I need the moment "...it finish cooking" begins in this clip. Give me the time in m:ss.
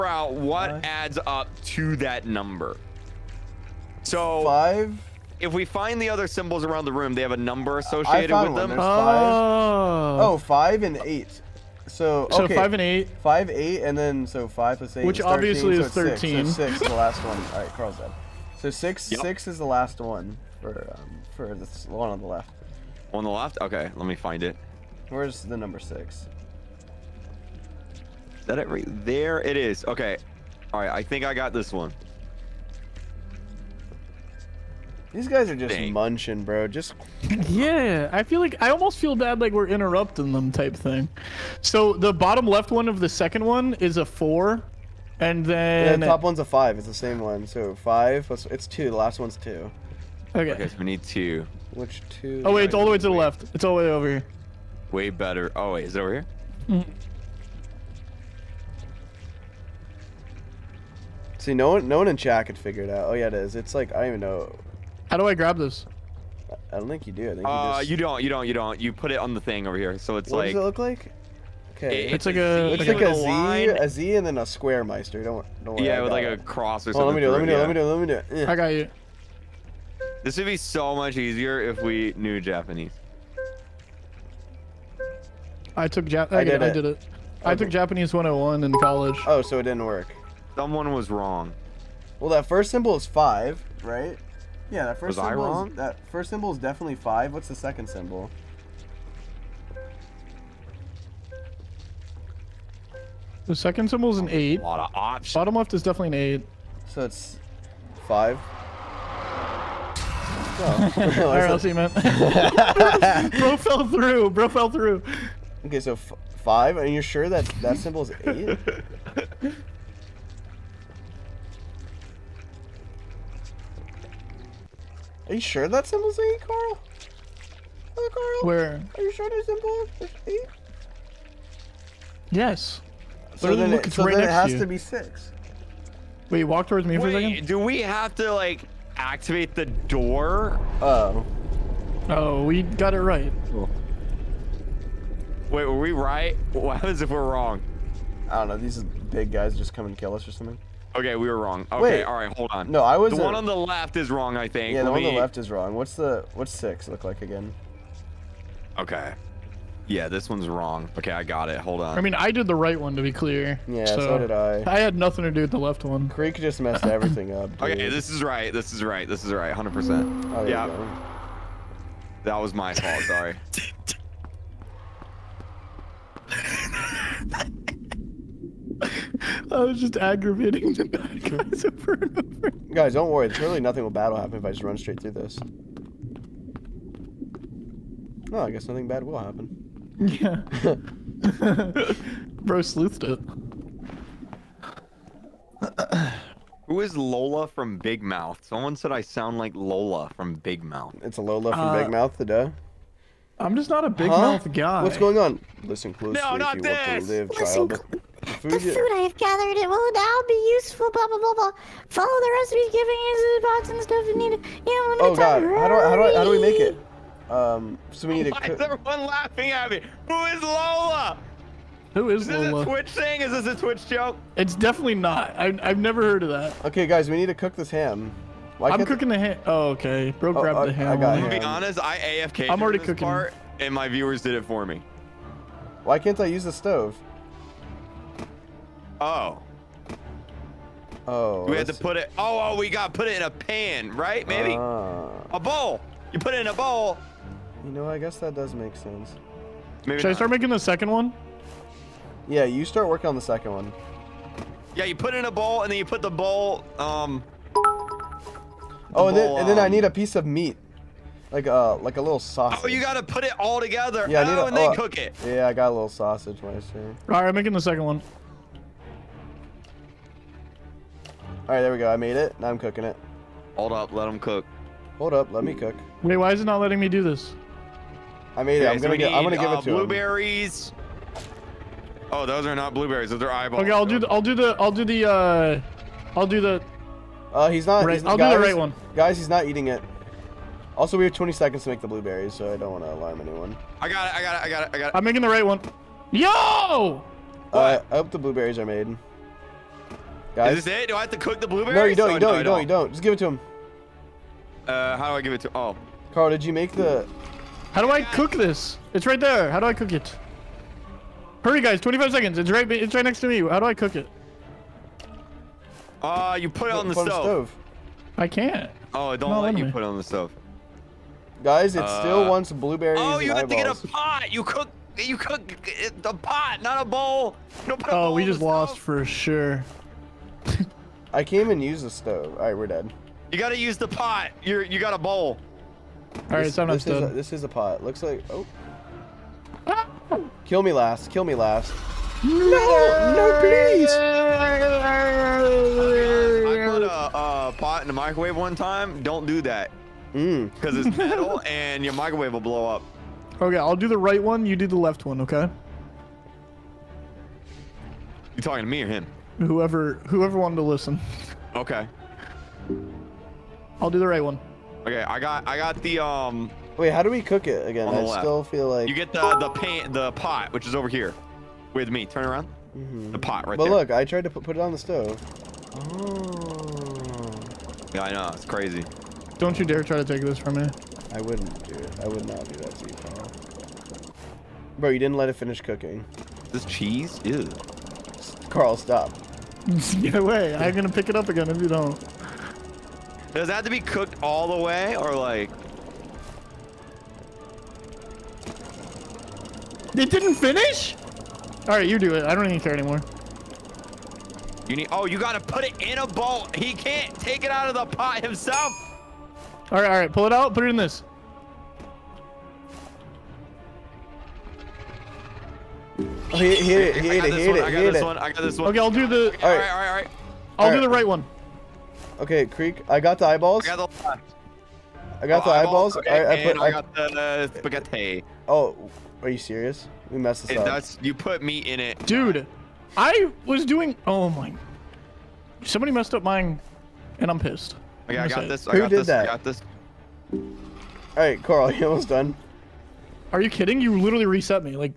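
6:25.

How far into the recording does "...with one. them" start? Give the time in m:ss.
0:08.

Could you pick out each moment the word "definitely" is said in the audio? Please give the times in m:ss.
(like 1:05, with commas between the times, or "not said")
1:36, 1:45, 3:44.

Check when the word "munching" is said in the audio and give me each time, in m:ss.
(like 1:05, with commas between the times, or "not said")
0:35.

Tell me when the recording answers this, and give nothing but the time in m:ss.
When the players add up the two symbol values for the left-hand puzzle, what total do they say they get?
0:15.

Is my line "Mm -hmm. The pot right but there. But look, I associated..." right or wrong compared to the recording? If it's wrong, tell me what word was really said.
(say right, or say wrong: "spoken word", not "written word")
wrong: "tried", not "associated".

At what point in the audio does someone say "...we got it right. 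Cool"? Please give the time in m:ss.
2:22.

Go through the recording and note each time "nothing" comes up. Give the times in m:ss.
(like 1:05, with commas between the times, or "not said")
2:44, 3:03, 3:08.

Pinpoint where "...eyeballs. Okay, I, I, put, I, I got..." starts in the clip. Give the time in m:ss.
7:05.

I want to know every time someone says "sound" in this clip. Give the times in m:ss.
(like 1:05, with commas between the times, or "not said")
3:19.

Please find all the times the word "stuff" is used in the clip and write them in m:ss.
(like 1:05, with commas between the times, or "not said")
3:33.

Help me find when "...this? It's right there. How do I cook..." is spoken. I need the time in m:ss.
5:08.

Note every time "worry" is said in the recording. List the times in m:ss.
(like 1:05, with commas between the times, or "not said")
1:15, 3:03.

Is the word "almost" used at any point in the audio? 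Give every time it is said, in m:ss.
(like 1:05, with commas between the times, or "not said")
0:38, 7:21.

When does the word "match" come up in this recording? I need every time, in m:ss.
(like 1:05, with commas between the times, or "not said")
not said.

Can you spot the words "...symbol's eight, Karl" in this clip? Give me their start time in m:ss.
2:05.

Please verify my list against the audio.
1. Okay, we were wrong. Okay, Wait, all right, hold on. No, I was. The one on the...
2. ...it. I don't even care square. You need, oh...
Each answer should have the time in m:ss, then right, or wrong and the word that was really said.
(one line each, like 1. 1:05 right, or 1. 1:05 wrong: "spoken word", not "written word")
1. 2:30 right
2. 6:42 wrong: "anymore", not "square".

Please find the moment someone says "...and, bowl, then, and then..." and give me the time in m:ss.
4:19.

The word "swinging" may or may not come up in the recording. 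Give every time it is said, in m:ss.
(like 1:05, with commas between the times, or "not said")
not said.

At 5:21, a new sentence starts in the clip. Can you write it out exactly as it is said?
Guys, it uh, still wants blueberries.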